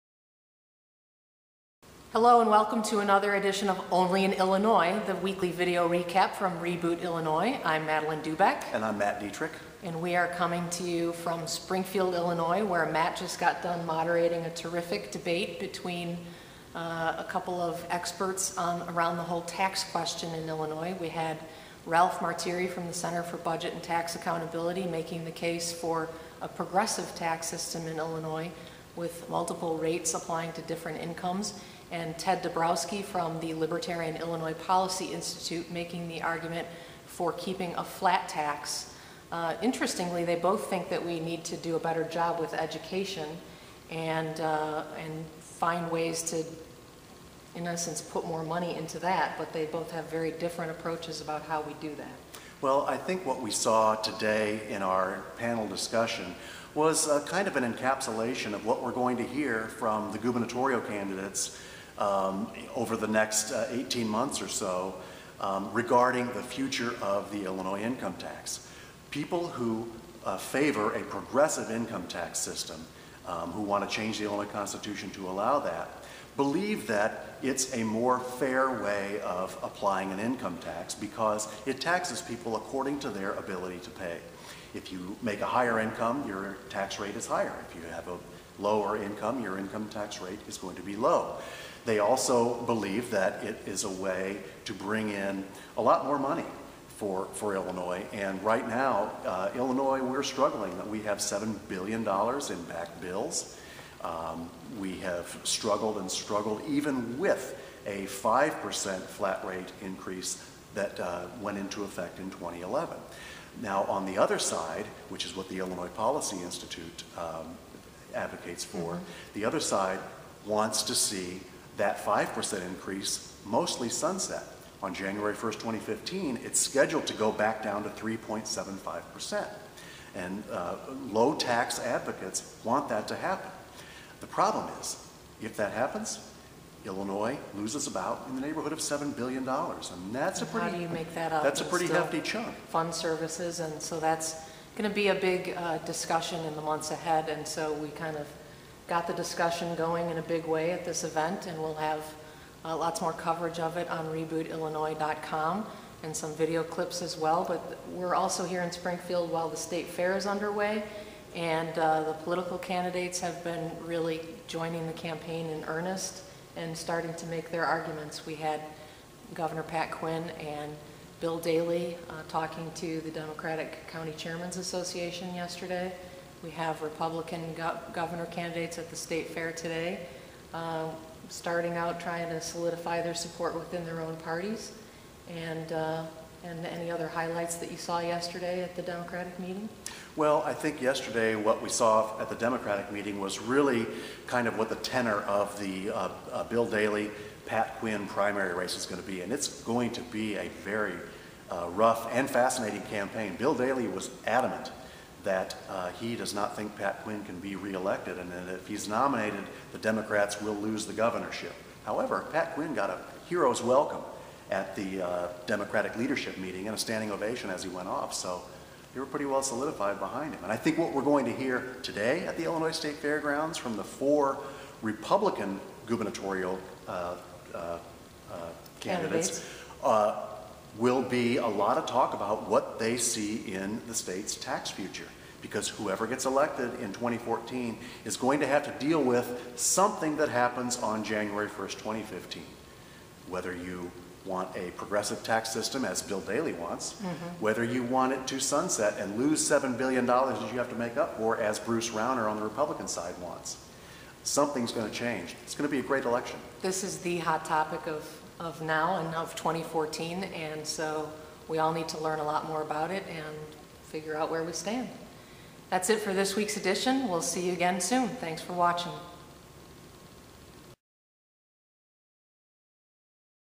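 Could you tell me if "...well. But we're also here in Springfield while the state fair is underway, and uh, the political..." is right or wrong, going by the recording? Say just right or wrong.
right.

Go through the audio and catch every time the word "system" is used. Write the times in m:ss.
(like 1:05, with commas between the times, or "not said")
0:27, 1:12, 4:05.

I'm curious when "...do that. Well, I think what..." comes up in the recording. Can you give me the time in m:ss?
0:51.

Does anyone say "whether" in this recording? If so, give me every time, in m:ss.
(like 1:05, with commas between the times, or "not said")
4:03, 4:07.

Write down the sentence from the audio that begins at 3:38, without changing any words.
So they were pretty well solidified behind him.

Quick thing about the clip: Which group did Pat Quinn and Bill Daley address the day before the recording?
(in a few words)
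Democratic County Chairmen's Association.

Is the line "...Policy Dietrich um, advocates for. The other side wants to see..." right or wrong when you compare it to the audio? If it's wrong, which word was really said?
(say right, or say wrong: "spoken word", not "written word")
wrong: "Institute", not "Dietrich".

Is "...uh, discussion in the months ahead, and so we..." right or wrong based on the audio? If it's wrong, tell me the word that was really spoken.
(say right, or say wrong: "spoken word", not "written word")
right.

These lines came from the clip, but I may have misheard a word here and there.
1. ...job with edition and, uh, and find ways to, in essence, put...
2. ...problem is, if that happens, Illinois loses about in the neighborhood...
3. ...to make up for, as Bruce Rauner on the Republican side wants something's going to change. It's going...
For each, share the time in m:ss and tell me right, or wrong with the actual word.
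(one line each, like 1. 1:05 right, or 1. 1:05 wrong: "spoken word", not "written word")
1. 0:42 wrong: "education", not "edition"
2. 2:14 right
3. 4:10 right.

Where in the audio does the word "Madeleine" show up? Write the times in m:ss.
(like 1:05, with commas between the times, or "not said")
0:07.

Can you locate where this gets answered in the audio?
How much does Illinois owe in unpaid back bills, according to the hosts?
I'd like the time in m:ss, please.
1:41.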